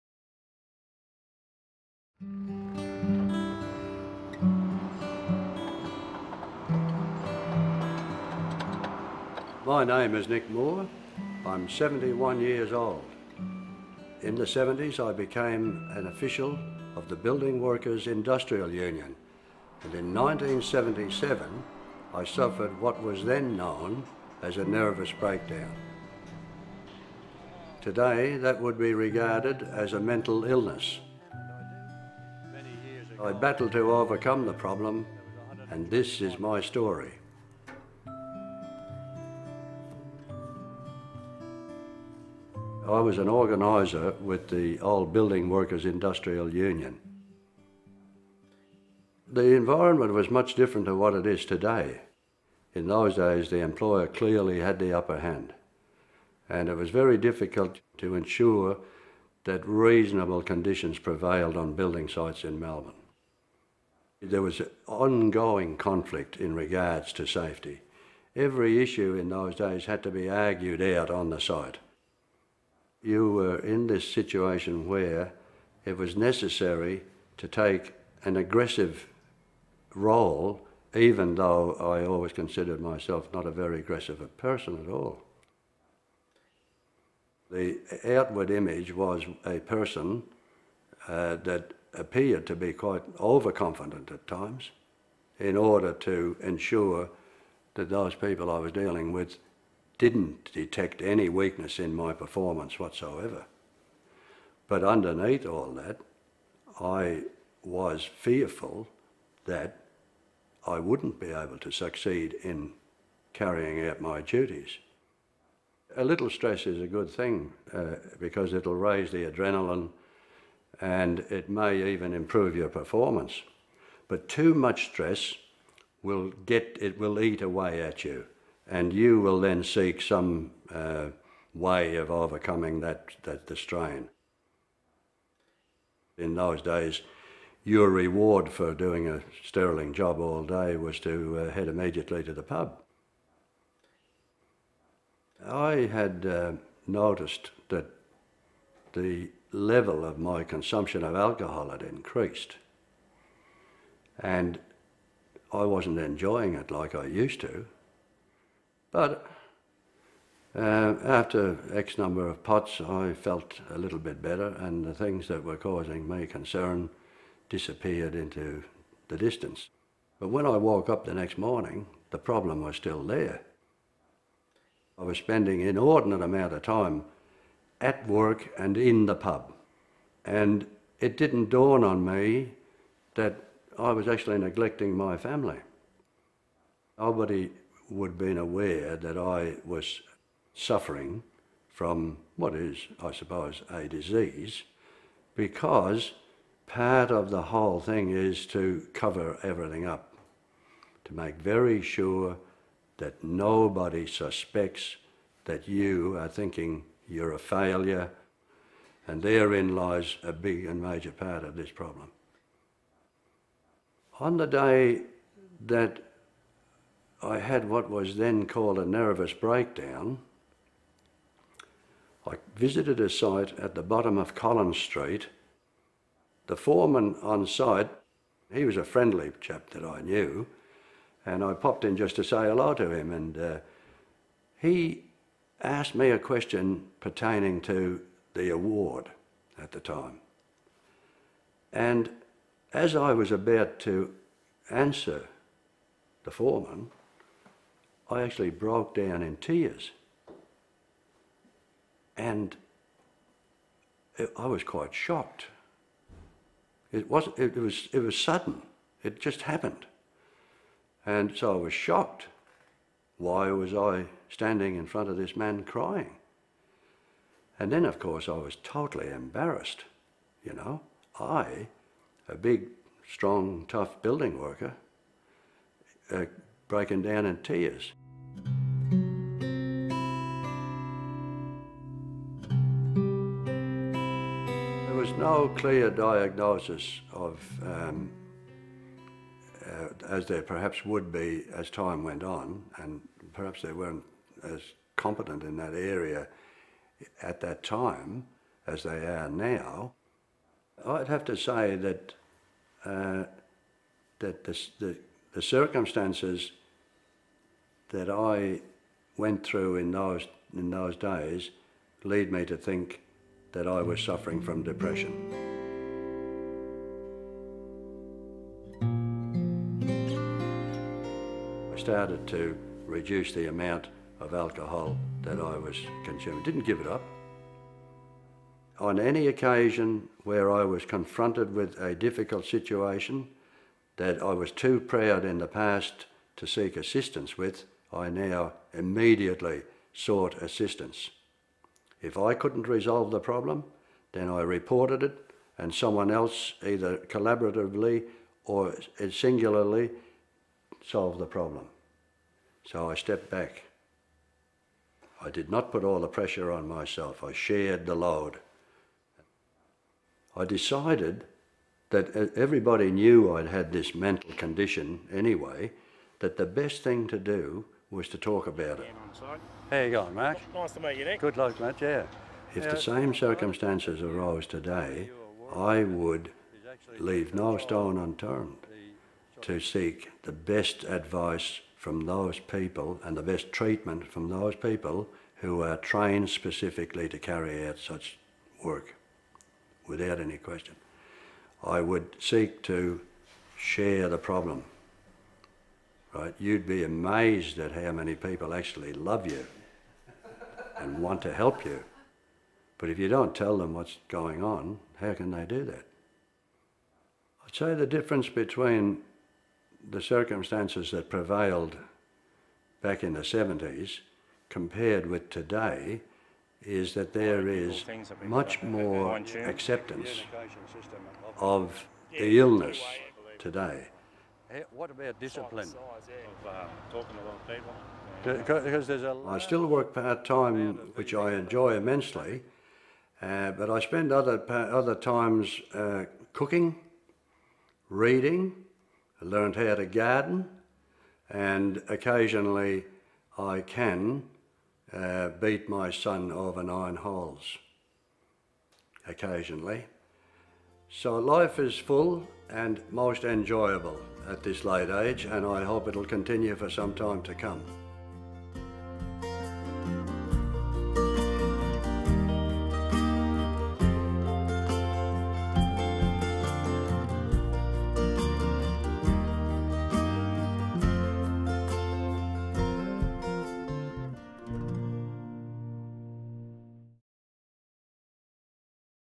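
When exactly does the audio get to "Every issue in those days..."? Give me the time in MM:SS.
01:08.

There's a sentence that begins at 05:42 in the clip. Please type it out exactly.
If I couldn't resolve the problem, then I reported it, and someone else, either collaboratively or singularly, solved the problem.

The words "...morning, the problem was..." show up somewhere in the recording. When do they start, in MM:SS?
02:51.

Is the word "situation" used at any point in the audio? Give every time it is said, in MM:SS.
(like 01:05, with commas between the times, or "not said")
01:14, 05:32.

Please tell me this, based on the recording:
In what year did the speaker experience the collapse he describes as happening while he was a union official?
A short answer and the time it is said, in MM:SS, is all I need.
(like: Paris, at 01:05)
1977, at 00:20.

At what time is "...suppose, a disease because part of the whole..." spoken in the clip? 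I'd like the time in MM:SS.
03:13.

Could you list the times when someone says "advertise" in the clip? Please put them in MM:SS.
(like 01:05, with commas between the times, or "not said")
not said.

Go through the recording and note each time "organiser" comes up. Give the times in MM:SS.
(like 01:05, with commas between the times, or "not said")
00:43.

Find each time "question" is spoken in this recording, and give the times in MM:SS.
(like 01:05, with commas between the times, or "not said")
03:56, 06:30.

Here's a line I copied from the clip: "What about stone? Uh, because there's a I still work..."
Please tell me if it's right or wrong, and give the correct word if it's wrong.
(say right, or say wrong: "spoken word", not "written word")
wrong: "discipline", not "stone".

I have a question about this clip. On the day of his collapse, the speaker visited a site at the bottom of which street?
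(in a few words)
Collins Street.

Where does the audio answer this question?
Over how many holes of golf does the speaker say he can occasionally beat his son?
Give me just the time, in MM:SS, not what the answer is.
07:26.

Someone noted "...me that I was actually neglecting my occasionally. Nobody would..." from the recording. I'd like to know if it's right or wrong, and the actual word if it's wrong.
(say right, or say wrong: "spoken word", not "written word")
wrong: "family", not "occasionally".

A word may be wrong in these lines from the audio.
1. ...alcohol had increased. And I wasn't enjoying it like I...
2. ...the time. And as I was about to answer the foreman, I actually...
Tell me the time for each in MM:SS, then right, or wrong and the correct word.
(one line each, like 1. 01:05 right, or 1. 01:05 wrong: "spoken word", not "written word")
1. 02:31 right
2. 03:59 right.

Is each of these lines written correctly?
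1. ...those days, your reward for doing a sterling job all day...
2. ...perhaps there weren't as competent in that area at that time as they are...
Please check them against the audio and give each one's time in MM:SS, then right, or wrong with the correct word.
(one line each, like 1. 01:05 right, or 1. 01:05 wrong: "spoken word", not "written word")
1. 02:16 right
2. 04:53 right.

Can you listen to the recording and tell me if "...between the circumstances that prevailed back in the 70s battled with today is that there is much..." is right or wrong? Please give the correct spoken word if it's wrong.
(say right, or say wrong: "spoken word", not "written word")
wrong: "compared", not "battled".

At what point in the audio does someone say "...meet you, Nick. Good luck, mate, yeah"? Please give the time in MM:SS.
06:10.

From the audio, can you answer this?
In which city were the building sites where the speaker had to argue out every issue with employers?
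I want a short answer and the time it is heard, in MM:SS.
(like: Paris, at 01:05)
Melbourne, at 01:02.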